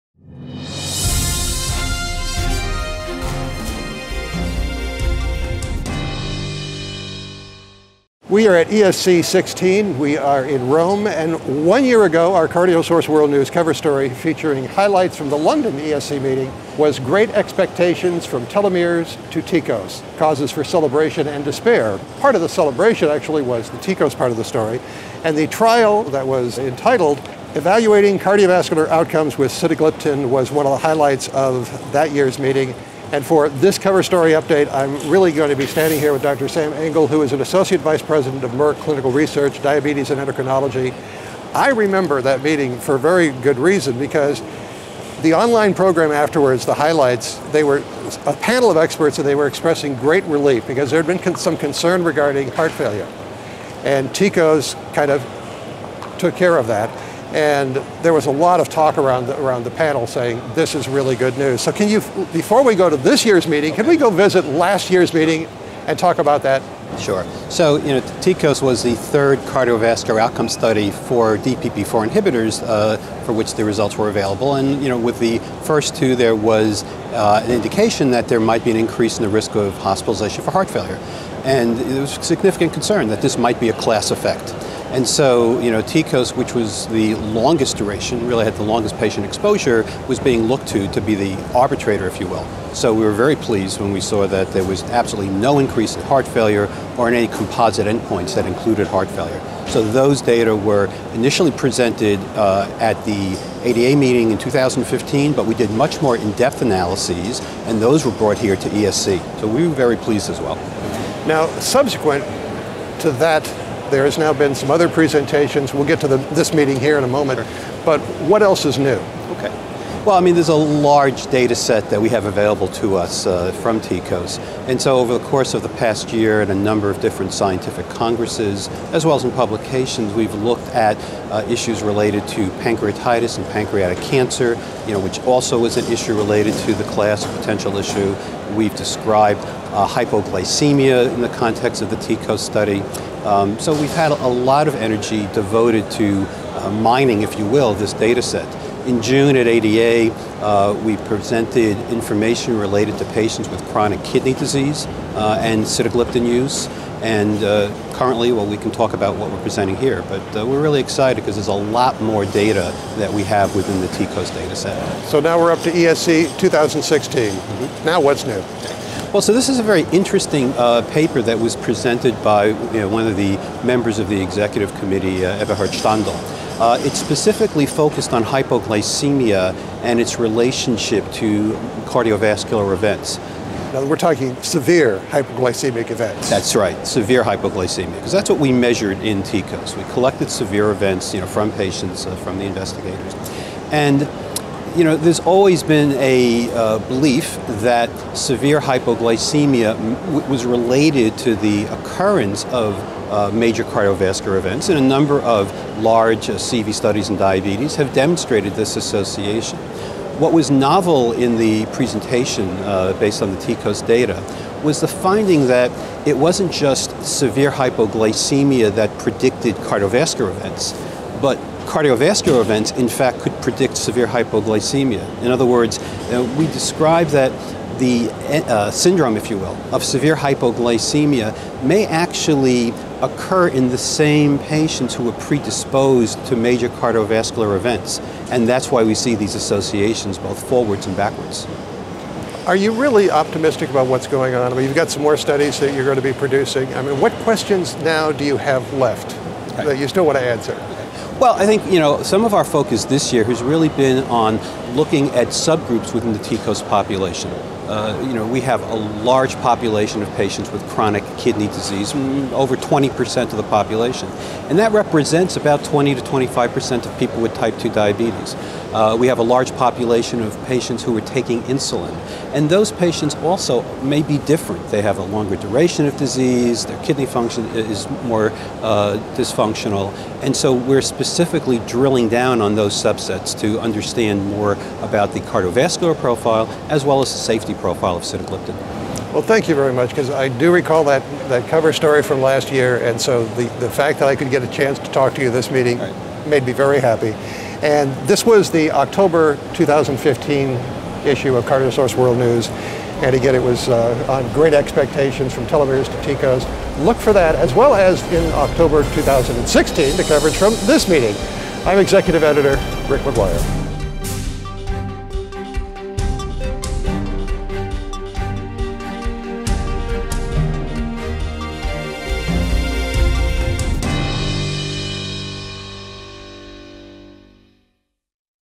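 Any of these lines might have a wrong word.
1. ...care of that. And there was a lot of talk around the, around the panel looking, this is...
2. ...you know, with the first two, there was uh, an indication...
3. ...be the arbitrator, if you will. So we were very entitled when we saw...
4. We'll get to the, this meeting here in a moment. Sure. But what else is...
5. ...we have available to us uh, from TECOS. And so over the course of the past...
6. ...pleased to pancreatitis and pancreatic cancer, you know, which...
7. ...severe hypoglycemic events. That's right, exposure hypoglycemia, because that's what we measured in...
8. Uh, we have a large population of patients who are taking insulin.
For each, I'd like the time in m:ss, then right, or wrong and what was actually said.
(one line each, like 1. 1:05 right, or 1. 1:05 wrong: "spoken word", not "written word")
1. 0:56 wrong: "saying", not "looking"
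2. 1:14 right
3. 1:30 wrong: "pleased", not "entitled"
4. 1:55 right
5. 2:02 right
6. 2:11 wrong: "related", not "pleased"
7. 3:04 wrong: "severe", not "exposure"
8. 4:28 right.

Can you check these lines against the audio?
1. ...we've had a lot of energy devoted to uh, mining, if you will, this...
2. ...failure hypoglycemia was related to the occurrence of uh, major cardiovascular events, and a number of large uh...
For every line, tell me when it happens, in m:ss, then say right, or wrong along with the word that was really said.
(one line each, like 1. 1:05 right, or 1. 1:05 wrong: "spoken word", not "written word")
1. 2:23 right
2. 3:18 wrong: "severe", not "failure".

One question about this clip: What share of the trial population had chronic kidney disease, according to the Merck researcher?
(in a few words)
over 20%.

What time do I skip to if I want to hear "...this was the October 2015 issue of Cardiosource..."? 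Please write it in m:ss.
4:58.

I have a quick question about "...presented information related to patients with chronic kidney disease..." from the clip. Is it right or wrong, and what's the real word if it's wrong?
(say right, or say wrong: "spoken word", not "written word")
right.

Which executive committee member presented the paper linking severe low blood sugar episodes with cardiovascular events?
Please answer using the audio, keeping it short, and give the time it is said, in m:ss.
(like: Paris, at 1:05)
Eberhard Standl, at 2:55.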